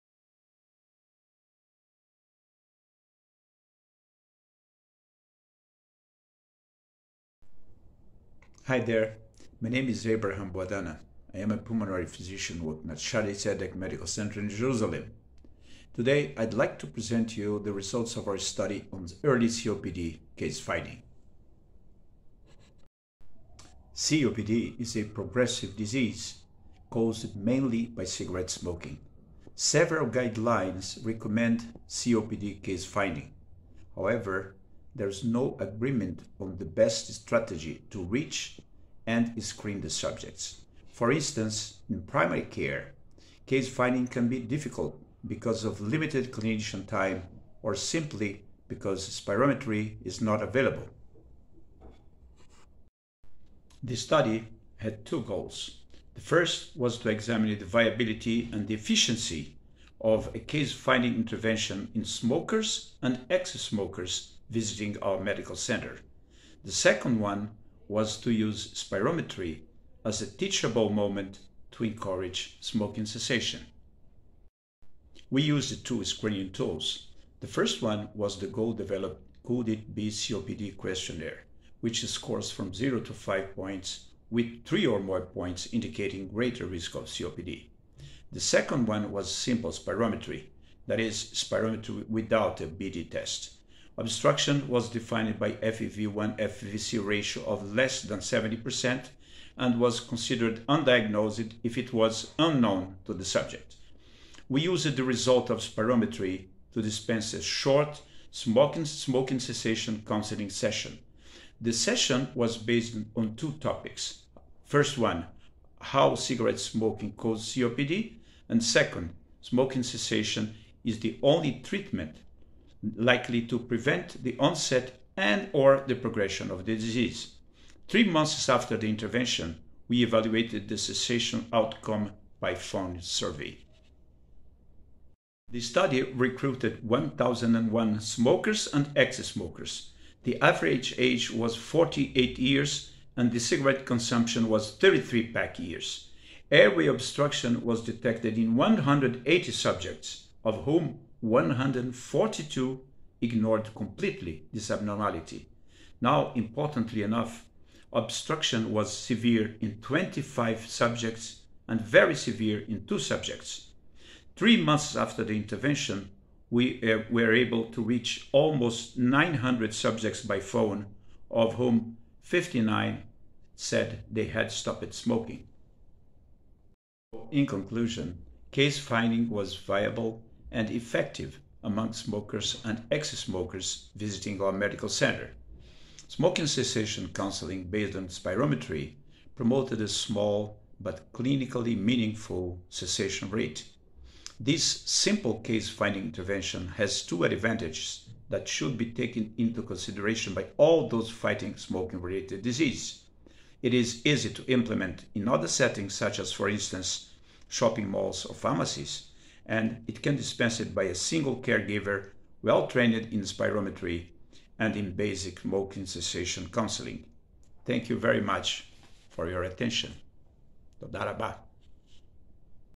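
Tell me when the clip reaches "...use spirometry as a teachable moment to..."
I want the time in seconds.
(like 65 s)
68 s.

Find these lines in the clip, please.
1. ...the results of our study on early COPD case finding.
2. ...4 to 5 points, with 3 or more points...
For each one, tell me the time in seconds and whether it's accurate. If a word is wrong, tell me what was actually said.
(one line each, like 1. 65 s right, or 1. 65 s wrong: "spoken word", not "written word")
1. 17 s right
2. 82 s wrong: "0", not "4".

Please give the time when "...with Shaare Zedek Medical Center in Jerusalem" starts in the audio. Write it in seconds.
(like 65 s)
12 s.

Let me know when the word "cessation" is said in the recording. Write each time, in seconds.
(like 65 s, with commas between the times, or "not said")
73 s, 109 s, 119 s, 130 s, 186 s, 192 s, 215 s.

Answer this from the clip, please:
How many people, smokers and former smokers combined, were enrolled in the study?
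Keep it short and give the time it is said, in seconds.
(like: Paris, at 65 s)
1,001, at 136 s.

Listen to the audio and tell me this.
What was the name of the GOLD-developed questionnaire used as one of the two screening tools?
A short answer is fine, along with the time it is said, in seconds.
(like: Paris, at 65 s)
Could It Be COPD, at 79 s.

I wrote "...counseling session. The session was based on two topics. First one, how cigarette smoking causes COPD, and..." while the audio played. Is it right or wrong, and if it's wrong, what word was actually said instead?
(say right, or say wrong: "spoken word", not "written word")
right.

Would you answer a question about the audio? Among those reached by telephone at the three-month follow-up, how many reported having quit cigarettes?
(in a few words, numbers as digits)
59.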